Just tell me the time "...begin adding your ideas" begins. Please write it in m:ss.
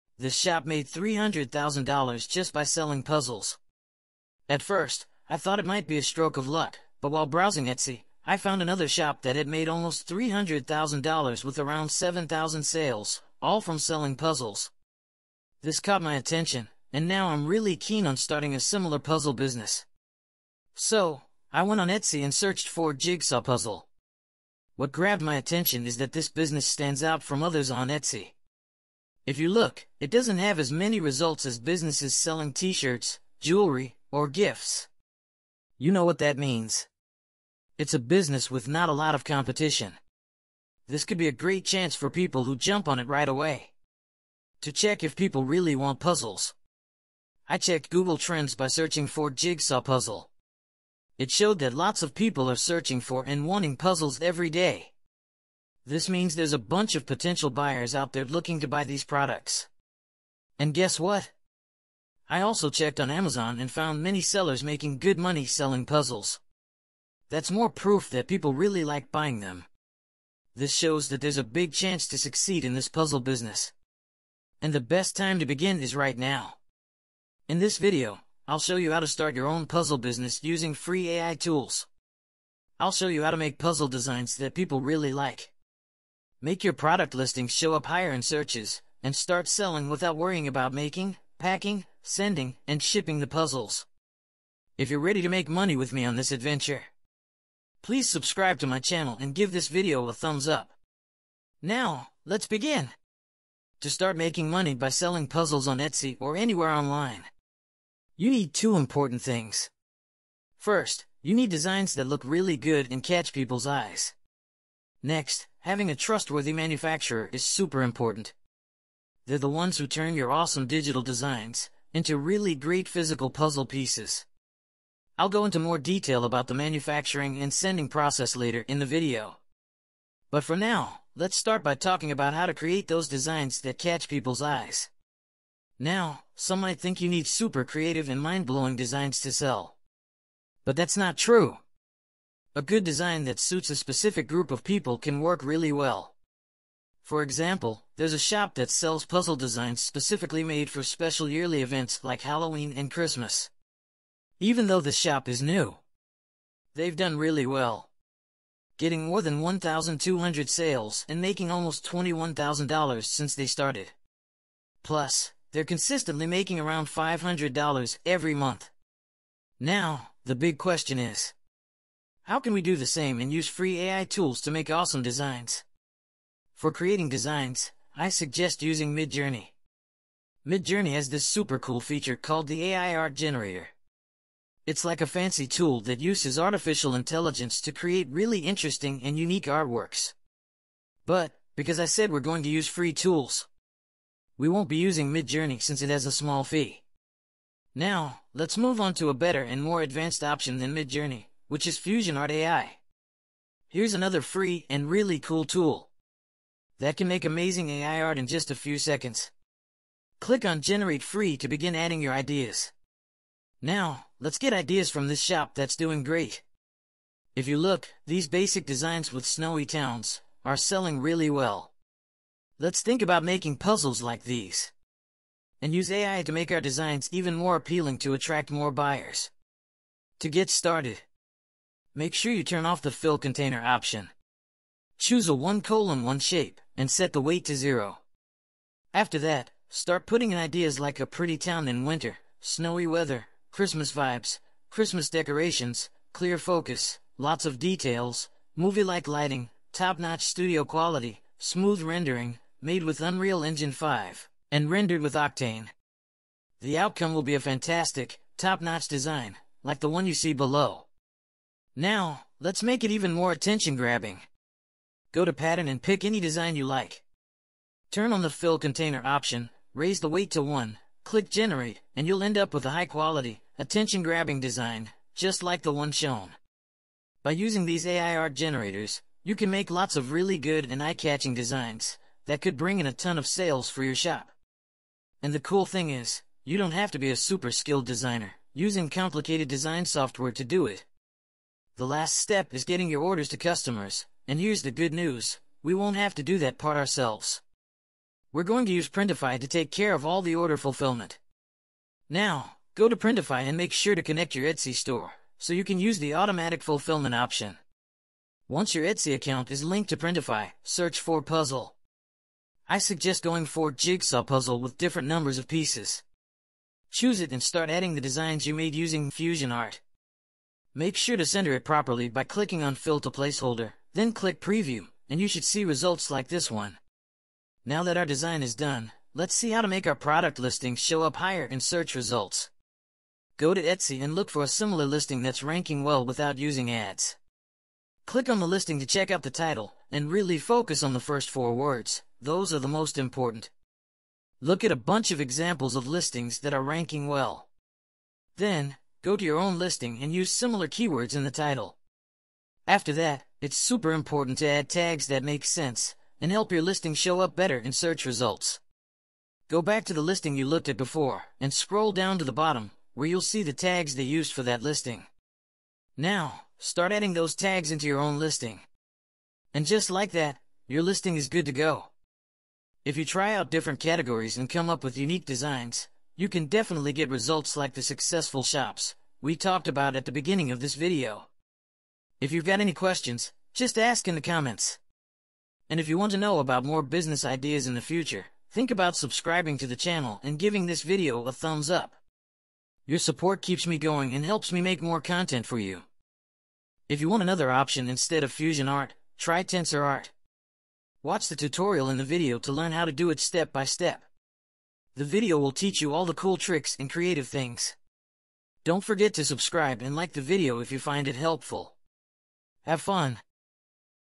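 3:31.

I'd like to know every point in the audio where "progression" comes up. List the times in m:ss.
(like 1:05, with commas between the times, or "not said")
not said.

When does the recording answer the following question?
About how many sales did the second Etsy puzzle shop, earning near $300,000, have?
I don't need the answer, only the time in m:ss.
0:11.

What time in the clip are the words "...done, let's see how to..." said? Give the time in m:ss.
5:28.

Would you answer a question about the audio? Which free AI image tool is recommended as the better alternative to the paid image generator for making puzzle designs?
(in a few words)
FusionArt AI.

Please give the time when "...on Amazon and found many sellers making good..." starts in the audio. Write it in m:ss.
1:02.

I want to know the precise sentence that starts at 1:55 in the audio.
Next, Having a trustworthy manufacturer is super important.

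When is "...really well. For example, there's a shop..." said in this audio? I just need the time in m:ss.
2:25.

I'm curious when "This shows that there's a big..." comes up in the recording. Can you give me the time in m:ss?
1:10.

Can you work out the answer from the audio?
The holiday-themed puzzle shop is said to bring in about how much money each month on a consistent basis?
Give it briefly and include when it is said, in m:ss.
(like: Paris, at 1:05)
$500, at 2:46.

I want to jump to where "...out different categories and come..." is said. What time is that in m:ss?
6:13.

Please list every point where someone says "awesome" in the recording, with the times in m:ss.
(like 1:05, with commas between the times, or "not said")
2:00, 2:54.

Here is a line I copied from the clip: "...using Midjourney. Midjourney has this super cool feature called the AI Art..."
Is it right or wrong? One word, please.
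right.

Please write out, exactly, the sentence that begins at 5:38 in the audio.
Click on the listing to check out the title, and really focus on the first four words.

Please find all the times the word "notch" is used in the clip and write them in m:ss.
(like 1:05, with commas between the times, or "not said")
4:09, 4:18.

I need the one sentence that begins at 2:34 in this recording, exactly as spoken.
Even though the shop is new, they've done really well, getting more than 1,200 sales and making almost $21,000 since they started.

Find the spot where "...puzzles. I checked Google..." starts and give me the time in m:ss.
0:45.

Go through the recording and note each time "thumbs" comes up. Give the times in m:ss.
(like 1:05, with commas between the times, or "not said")
1:40, 6:31.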